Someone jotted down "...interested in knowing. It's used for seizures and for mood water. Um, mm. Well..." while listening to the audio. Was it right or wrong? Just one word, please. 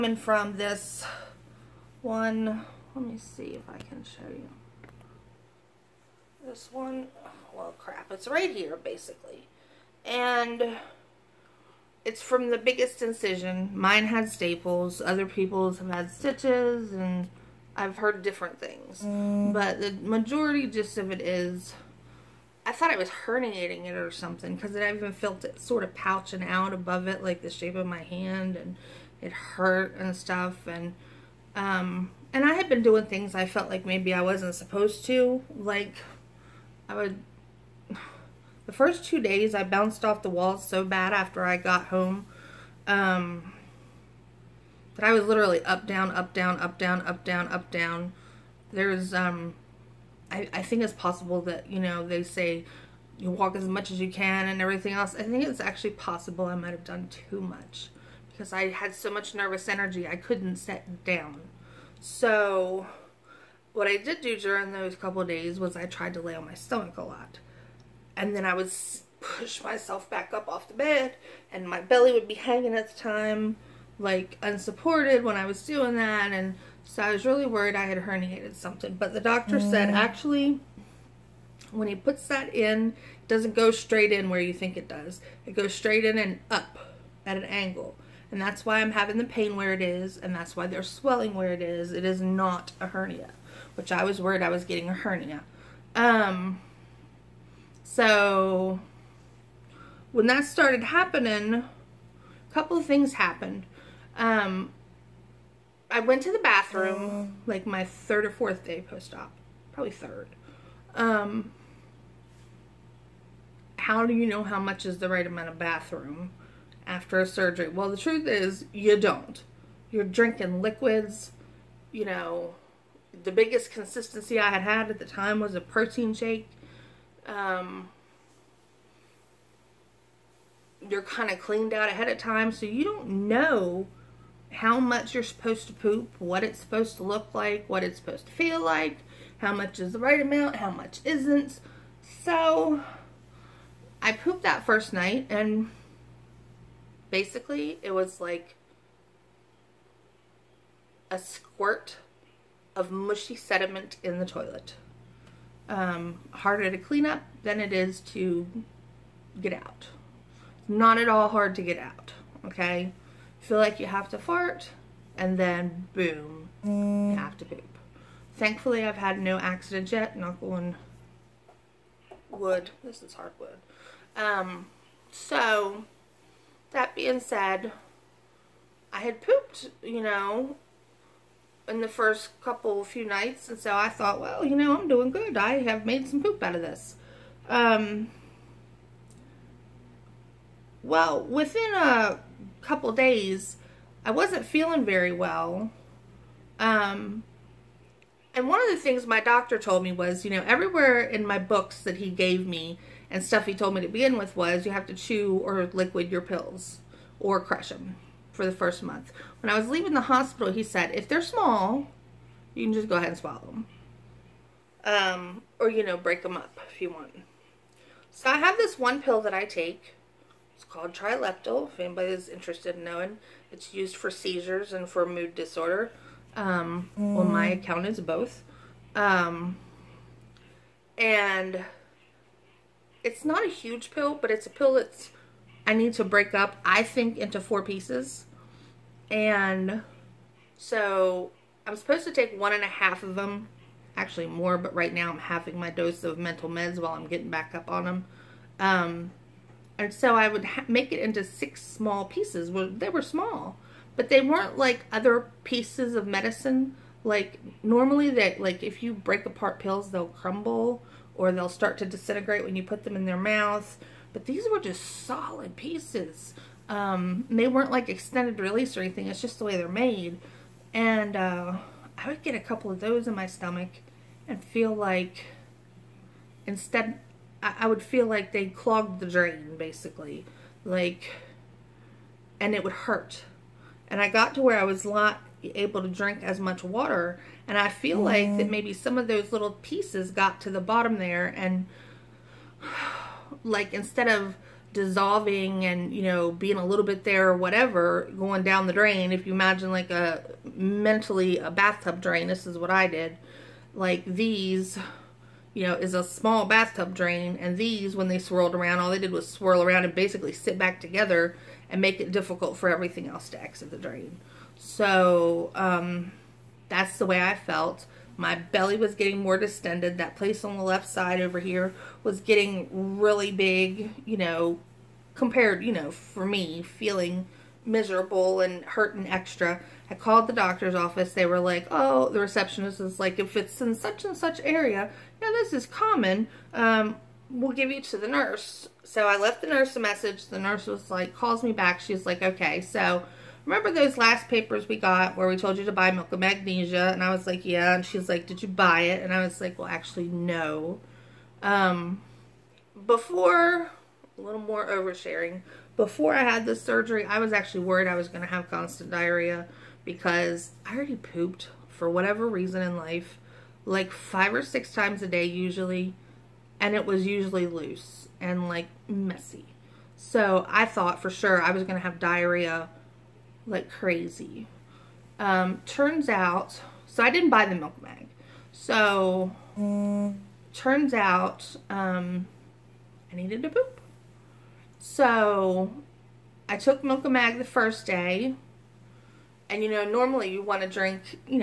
wrong.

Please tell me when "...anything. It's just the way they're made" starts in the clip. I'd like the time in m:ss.
4:28.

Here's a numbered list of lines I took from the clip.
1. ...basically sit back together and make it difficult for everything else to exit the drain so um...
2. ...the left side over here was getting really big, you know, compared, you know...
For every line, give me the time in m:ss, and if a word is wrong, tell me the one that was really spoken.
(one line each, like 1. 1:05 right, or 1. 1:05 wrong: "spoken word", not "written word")
1. 5:09 right
2. 5:20 right.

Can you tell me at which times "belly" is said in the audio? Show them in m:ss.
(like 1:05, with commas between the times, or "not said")
1:11, 5:18.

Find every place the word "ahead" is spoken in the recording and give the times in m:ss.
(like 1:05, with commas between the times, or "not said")
2:11, 3:32.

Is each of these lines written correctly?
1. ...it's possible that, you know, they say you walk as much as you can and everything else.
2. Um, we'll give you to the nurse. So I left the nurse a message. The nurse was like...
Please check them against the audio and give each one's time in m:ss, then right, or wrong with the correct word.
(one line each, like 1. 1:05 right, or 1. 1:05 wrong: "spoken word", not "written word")
1. 0:50 right
2. 5:36 right.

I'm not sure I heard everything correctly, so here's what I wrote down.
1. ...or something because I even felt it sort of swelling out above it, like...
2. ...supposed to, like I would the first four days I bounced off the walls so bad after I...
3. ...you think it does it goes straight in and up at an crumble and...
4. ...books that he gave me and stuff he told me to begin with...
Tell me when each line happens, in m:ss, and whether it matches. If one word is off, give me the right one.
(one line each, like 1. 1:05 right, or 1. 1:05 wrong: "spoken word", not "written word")
1. 0:23 wrong: "pouching", not "swelling"
2. 0:34 wrong: "two", not "four"
3. 1:24 wrong: "angle", not "crumble"
4. 3:21 right.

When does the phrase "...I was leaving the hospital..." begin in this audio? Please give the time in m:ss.
3:29.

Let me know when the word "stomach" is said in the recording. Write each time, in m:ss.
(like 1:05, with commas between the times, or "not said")
1:06, 4:33.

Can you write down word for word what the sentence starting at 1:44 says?
Um, I went to the bathroom like my third or fourth day post-op, probably third.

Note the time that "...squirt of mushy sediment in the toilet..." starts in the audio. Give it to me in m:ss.
2:31.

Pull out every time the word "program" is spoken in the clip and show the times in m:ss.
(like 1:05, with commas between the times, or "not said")
not said.